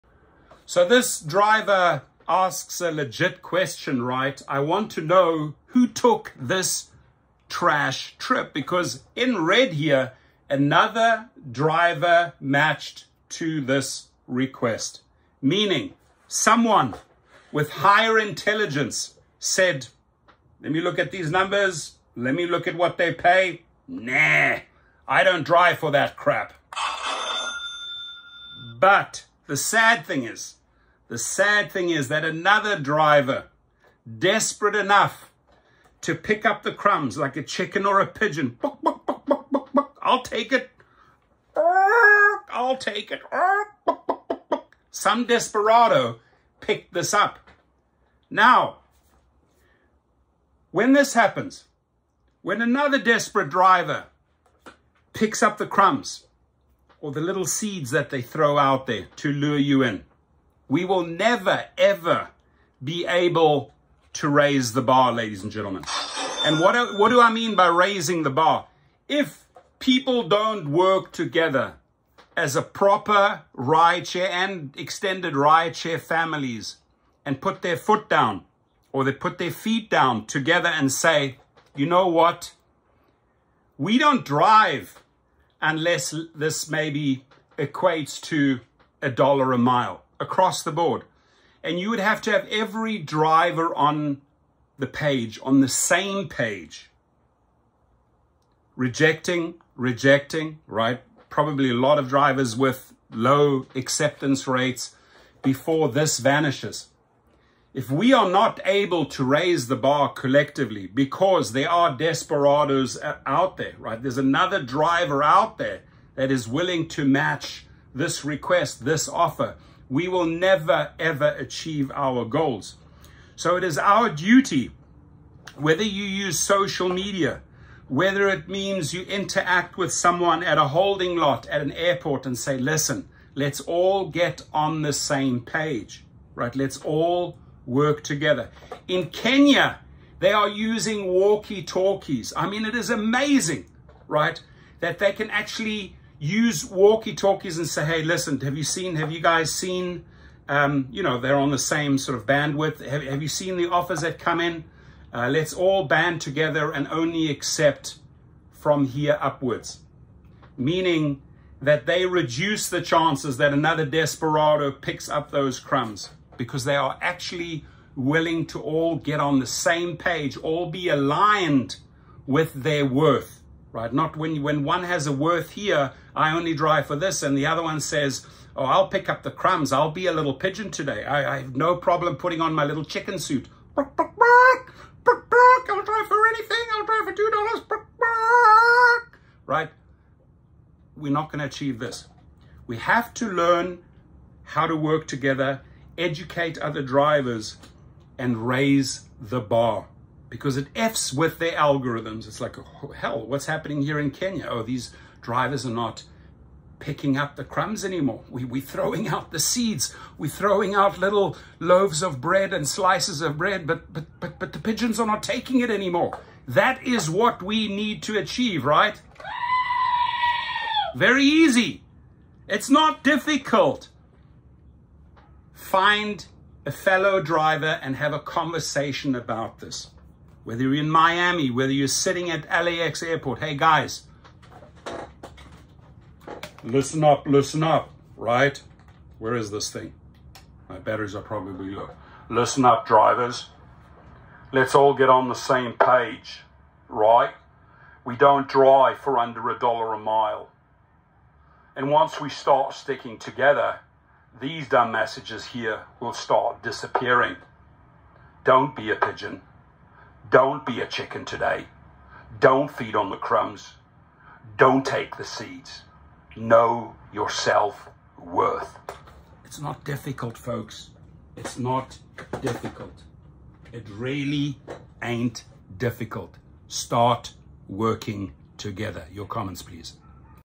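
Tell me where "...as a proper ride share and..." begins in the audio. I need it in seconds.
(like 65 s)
72 s.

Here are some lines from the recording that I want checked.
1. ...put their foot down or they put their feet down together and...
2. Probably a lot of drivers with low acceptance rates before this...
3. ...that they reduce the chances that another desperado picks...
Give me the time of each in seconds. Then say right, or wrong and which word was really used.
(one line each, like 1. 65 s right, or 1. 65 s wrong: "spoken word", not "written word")
1. 77 s right
2. 101 s right
3. 161 s right.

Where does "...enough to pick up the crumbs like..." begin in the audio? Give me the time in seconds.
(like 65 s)
34 s.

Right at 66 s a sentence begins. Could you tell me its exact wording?
And what, do, what do I mean by raising the bar?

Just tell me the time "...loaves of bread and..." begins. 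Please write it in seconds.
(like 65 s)
211 s.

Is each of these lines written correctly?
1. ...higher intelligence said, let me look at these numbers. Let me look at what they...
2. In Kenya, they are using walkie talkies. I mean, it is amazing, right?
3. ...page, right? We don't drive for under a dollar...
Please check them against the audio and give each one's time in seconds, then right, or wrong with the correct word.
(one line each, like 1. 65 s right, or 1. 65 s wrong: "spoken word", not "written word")
1. 17 s right
2. 138 s right
3. 245 s right.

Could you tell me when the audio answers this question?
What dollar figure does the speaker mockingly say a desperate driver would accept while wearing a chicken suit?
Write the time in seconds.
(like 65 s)
187 s.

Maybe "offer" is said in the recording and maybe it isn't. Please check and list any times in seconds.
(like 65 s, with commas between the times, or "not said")
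119 s, 153 s.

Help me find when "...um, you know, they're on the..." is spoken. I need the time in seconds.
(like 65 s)
150 s.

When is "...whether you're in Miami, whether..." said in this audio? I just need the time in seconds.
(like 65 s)
230 s.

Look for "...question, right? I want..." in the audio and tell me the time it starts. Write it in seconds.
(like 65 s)
3 s.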